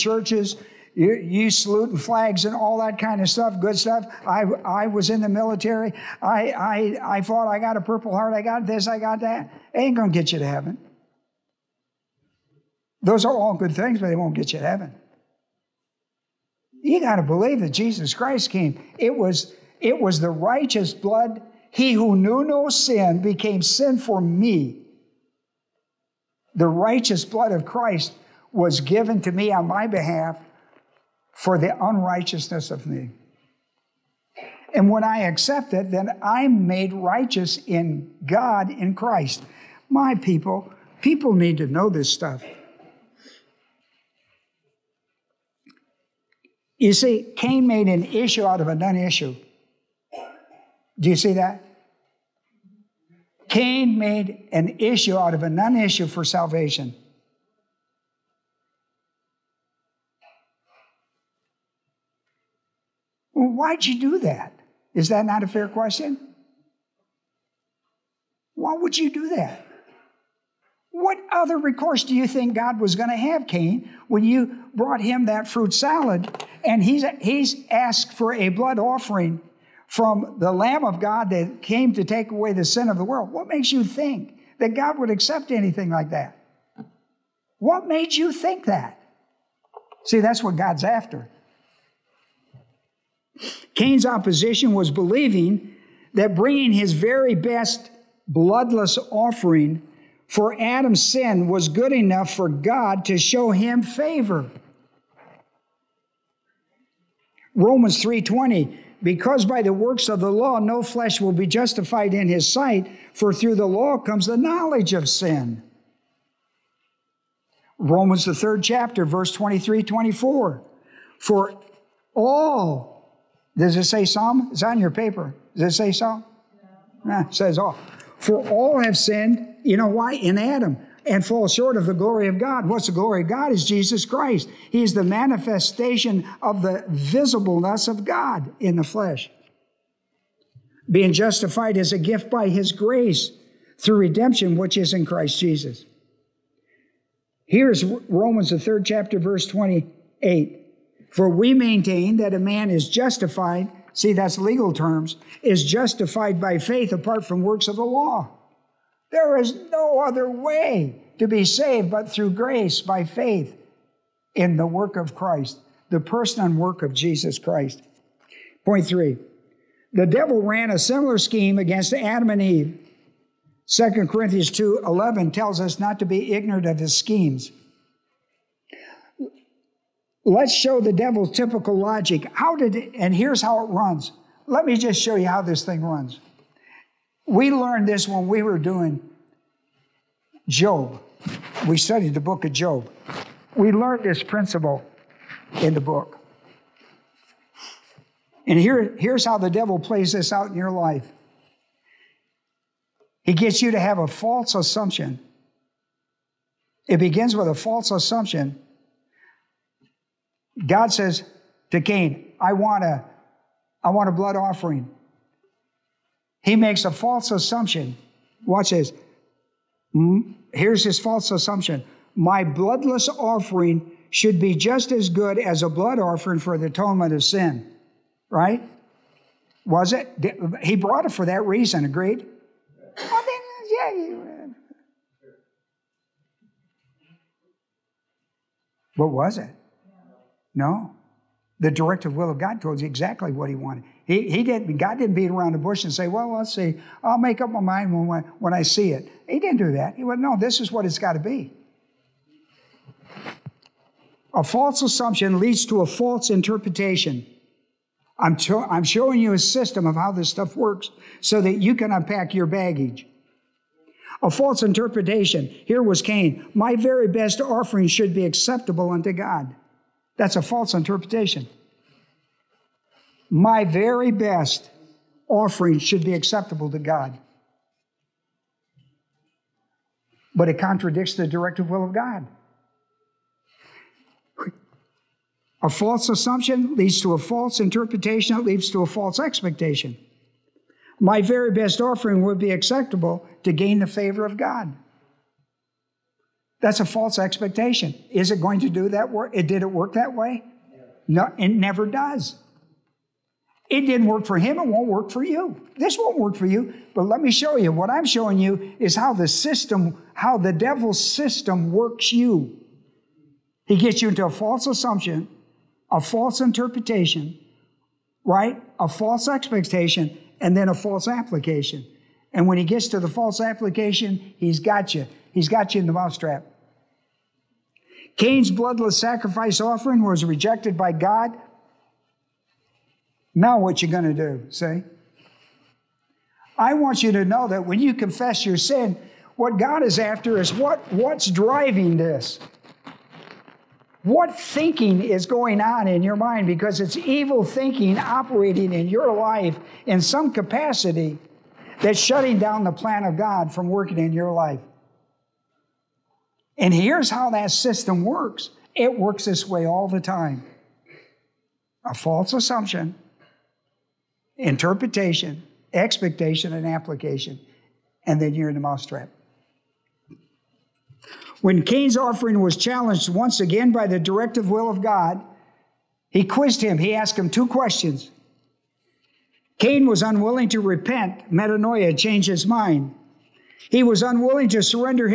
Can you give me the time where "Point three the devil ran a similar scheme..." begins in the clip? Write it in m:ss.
2:48.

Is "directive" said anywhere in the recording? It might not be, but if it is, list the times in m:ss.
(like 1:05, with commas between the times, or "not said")
4:01, 4:41, 6:13.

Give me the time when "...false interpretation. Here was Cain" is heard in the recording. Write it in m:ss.
4:24.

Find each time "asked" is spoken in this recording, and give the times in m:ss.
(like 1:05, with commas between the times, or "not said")
1:17, 6:16.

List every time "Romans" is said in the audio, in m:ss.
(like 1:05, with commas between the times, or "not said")
1:47, 1:57, 2:27.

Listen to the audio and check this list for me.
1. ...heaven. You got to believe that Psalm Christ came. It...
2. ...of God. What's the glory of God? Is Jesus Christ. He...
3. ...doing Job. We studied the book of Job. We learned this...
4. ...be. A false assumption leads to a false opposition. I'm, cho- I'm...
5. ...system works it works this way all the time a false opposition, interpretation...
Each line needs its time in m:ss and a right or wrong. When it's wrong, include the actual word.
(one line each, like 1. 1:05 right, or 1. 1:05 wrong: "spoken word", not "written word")
1. 0:14 wrong: "Jesus", not "Psalm"
2. 2:12 right
3. 3:08 right
4. 4:11 wrong: "interpretation", not "opposition"
5. 5:57 wrong: "assumption", not "opposition".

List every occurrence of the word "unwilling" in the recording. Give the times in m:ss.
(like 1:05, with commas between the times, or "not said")
6:20, 6:24.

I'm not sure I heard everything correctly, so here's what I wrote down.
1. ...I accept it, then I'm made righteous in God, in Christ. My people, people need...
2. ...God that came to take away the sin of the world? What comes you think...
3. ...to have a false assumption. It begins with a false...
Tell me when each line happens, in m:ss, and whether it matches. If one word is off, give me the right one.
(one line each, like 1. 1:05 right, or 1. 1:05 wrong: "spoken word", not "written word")
1. 0:35 right
2. 1:20 wrong: "makes", not "comes"
3. 3:23 right.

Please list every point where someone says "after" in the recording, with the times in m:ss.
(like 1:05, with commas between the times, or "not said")
1:30, 5:39.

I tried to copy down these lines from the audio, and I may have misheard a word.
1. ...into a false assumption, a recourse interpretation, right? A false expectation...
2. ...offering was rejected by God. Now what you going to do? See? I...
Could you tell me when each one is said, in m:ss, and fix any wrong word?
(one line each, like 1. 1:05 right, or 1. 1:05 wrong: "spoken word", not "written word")
1. 5:14 wrong: "false", not "recourse"
2. 5:29 right.